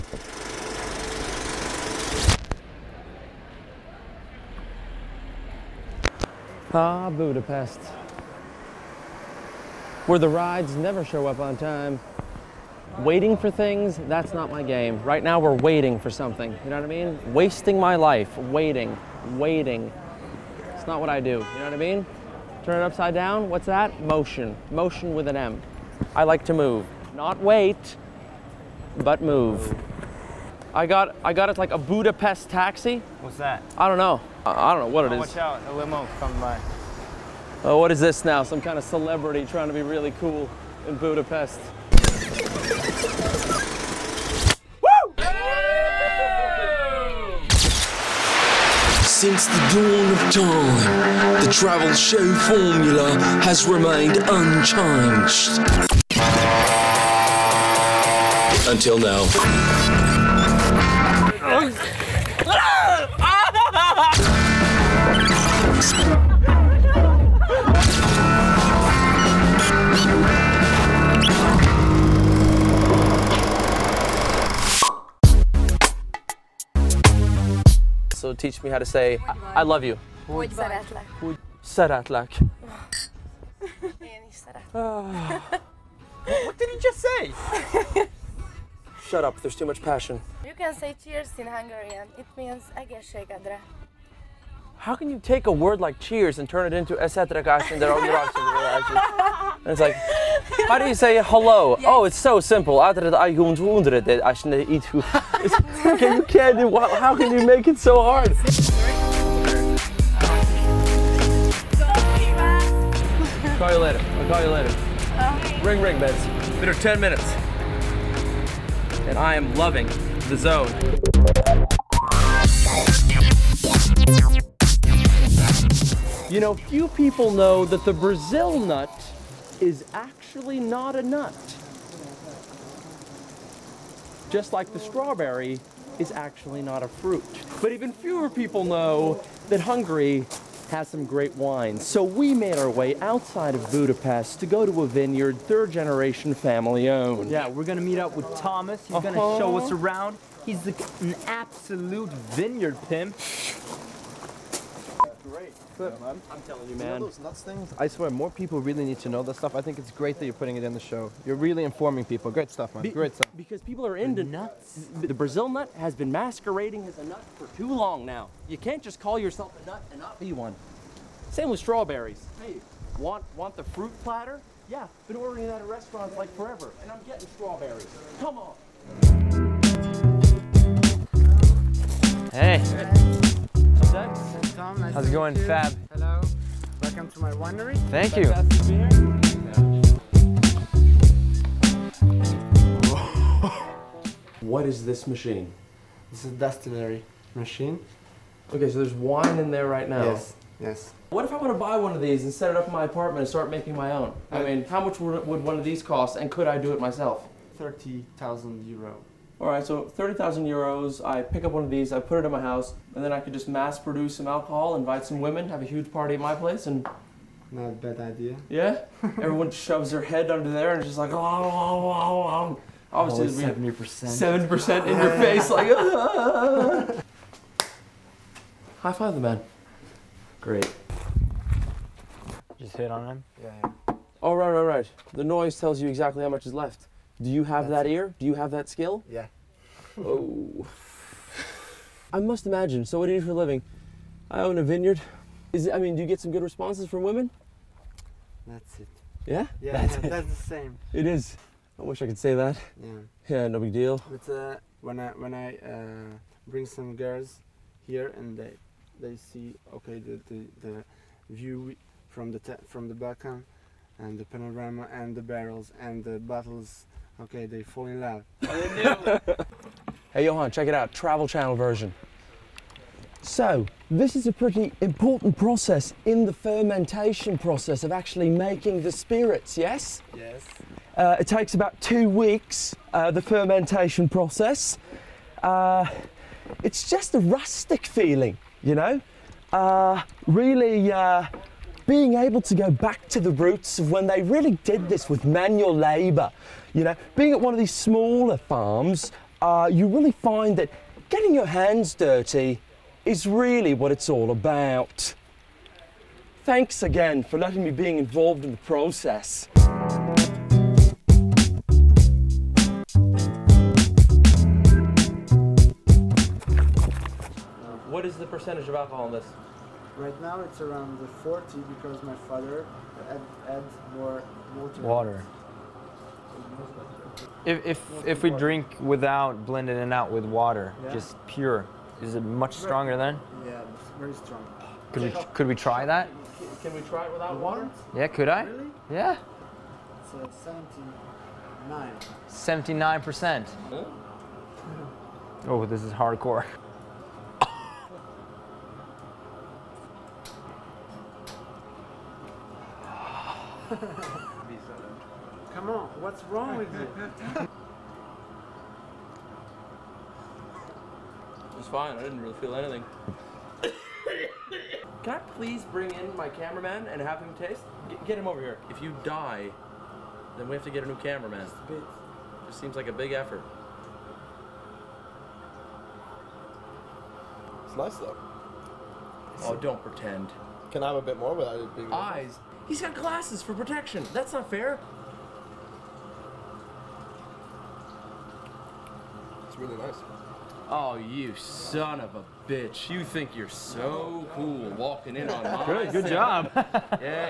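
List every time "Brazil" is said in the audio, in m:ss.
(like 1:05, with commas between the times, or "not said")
2:07, 2:45.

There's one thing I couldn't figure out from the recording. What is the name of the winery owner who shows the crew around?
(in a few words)
Thomas.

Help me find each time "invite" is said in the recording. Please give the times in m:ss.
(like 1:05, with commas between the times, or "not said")
3:34.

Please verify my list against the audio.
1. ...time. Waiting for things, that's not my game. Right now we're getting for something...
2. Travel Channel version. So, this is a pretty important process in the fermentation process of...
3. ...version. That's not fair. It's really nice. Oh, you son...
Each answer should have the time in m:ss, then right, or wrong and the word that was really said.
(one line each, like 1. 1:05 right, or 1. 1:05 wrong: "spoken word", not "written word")
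1. 0:11 wrong: "waiting", not "getting"
2. 4:30 right
3. 6:23 wrong: "protection", not "version".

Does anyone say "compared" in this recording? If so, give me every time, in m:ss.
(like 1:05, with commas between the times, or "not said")
not said.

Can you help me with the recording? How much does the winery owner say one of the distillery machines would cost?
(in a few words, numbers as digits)
30,000 euros.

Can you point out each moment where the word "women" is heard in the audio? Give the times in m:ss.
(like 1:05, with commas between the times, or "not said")
3:35, 4:07.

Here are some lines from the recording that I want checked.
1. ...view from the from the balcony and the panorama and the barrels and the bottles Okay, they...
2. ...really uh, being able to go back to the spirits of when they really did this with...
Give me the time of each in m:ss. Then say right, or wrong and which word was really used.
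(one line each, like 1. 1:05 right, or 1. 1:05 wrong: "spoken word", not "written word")
1. 4:21 right
2. 4:50 wrong: "roots", not "spirits".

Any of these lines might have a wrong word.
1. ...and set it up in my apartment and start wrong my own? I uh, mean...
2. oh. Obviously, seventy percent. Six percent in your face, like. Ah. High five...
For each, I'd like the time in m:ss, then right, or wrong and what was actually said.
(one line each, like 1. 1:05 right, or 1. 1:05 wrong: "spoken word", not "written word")
1. 3:22 wrong: "making", not "wrong"
2. 3:42 wrong: "Seven", not "Six".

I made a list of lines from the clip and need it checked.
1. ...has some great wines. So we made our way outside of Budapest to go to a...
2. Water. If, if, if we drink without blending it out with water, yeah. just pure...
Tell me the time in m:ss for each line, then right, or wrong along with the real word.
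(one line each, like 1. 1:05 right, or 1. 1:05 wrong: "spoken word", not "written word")
1. 2:20 right
2. 5:24 right.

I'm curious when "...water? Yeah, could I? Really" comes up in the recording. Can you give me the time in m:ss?
5:37.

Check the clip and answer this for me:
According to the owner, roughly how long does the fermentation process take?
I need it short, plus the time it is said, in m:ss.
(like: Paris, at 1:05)
2 weeks, at 4:41.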